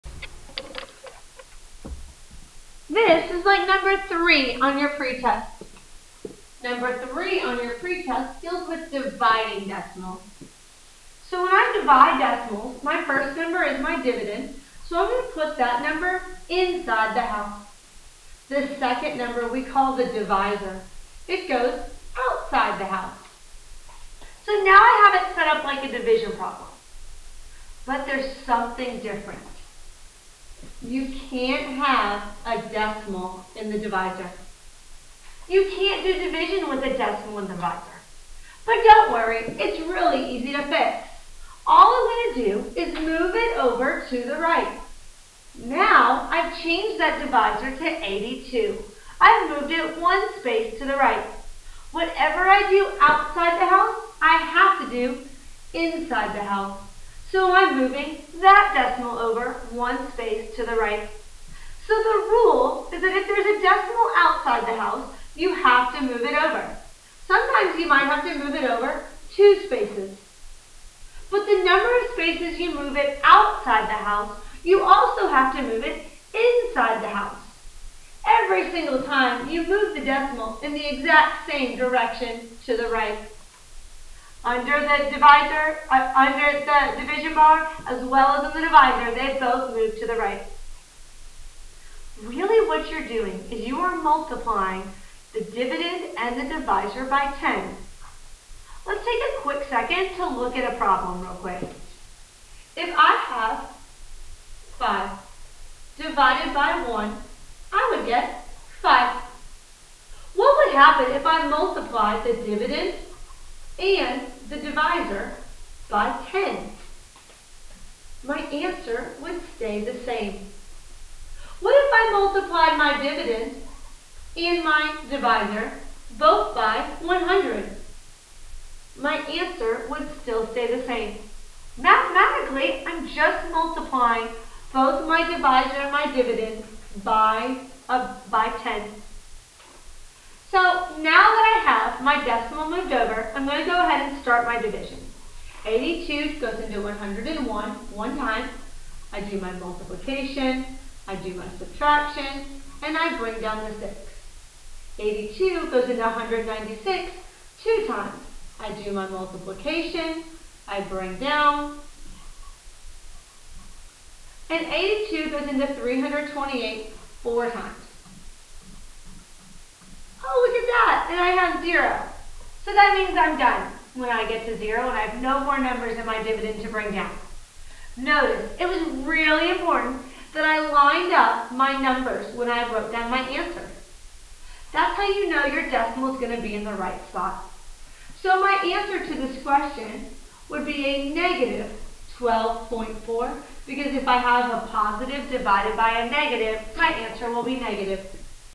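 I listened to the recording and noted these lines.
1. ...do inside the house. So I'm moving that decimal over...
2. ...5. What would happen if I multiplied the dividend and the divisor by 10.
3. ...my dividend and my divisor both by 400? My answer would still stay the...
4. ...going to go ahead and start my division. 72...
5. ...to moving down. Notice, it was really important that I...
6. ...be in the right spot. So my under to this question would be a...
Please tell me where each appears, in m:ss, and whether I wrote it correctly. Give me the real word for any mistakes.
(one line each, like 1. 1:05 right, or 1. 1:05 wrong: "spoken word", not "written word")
1. 0:54 right
2. 1:48 right
3. 2:02 wrong: "100", not "400"
4. 2:23 wrong: "82", not "72"
5. 2:56 wrong: "bring", not "moving"
6. 3:06 wrong: "answer", not "under".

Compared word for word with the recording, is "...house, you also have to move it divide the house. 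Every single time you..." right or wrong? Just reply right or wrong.
wrong.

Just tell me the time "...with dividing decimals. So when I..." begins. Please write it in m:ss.
0:08.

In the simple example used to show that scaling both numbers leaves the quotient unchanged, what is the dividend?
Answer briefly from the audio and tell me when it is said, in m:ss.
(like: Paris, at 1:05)
5, at 1:44.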